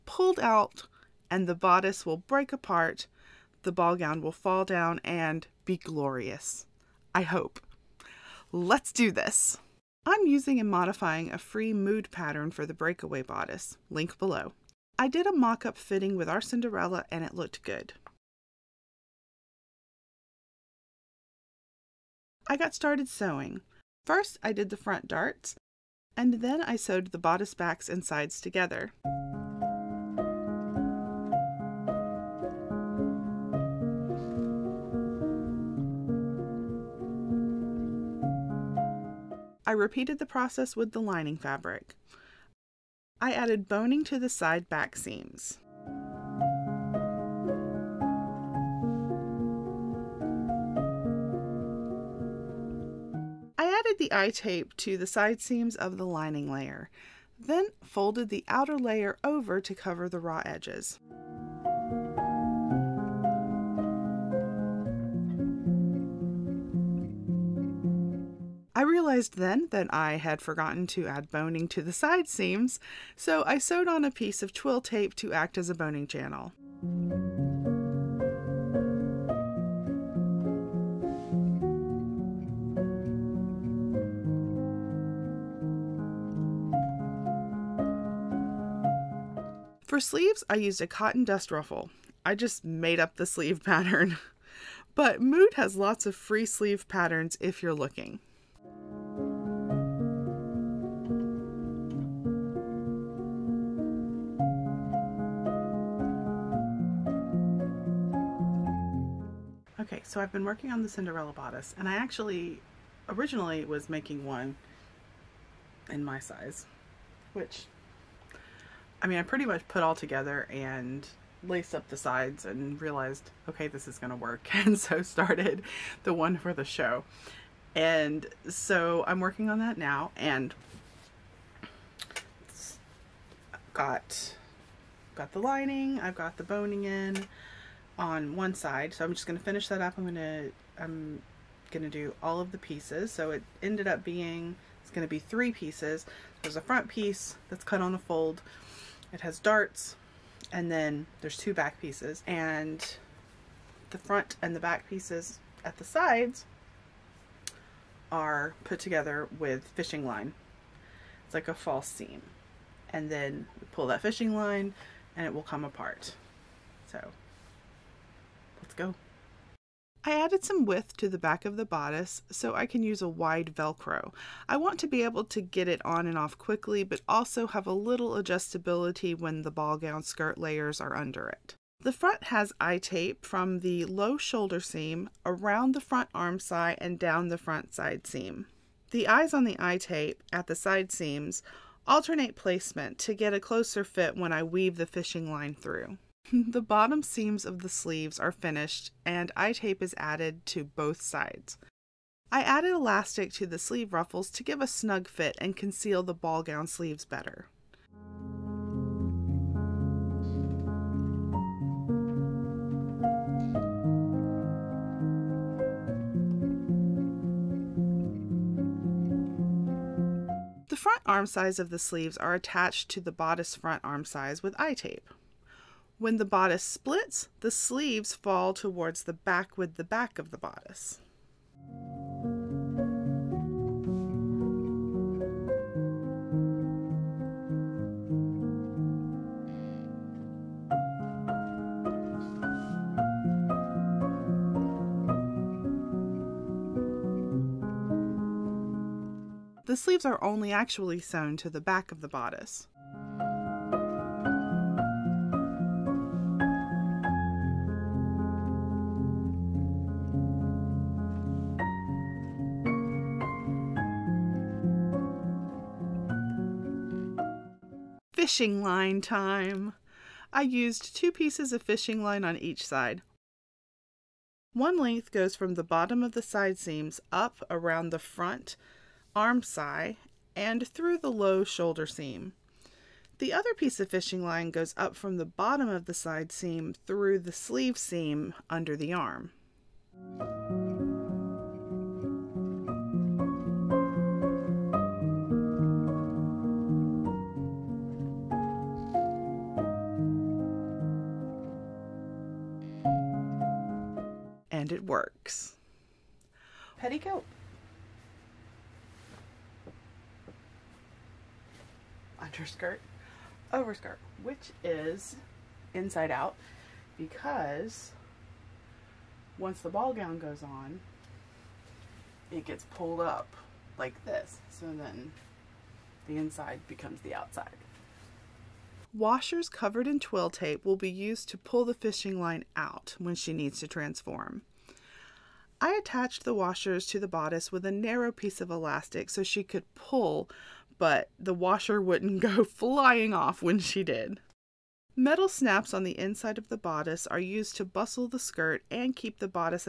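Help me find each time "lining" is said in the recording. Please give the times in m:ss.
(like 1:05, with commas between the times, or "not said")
0:41, 0:56, 2:15.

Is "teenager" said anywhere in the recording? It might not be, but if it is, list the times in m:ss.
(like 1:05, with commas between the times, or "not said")
not said.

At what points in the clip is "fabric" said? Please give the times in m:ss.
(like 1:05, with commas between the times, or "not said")
0:41.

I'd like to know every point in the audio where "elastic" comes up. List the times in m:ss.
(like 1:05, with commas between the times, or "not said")
3:22, 5:38.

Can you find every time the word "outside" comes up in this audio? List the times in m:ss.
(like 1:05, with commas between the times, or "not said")
5:27.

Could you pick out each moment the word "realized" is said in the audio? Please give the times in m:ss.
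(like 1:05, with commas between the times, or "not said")
1:08, 2:02.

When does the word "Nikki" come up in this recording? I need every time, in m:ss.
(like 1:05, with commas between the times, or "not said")
not said.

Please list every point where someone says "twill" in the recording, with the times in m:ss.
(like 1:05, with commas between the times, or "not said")
1:14, 5:30.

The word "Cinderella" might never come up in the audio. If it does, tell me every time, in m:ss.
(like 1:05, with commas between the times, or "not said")
0:16, 1:50.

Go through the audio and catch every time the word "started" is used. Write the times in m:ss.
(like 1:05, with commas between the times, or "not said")
0:22, 2:05.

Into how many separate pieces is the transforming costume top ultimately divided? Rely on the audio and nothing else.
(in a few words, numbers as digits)
3.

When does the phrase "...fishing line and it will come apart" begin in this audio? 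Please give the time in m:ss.
2:44.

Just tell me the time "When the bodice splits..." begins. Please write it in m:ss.
3:45.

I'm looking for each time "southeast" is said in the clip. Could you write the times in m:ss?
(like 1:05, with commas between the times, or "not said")
not said.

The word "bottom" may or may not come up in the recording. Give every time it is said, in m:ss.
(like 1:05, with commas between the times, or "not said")
3:16, 4:35, 4:45.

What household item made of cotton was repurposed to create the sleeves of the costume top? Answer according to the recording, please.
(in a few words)
Dust ruffle.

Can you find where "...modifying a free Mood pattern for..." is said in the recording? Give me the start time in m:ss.
0:10.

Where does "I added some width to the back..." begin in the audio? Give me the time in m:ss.
2:50.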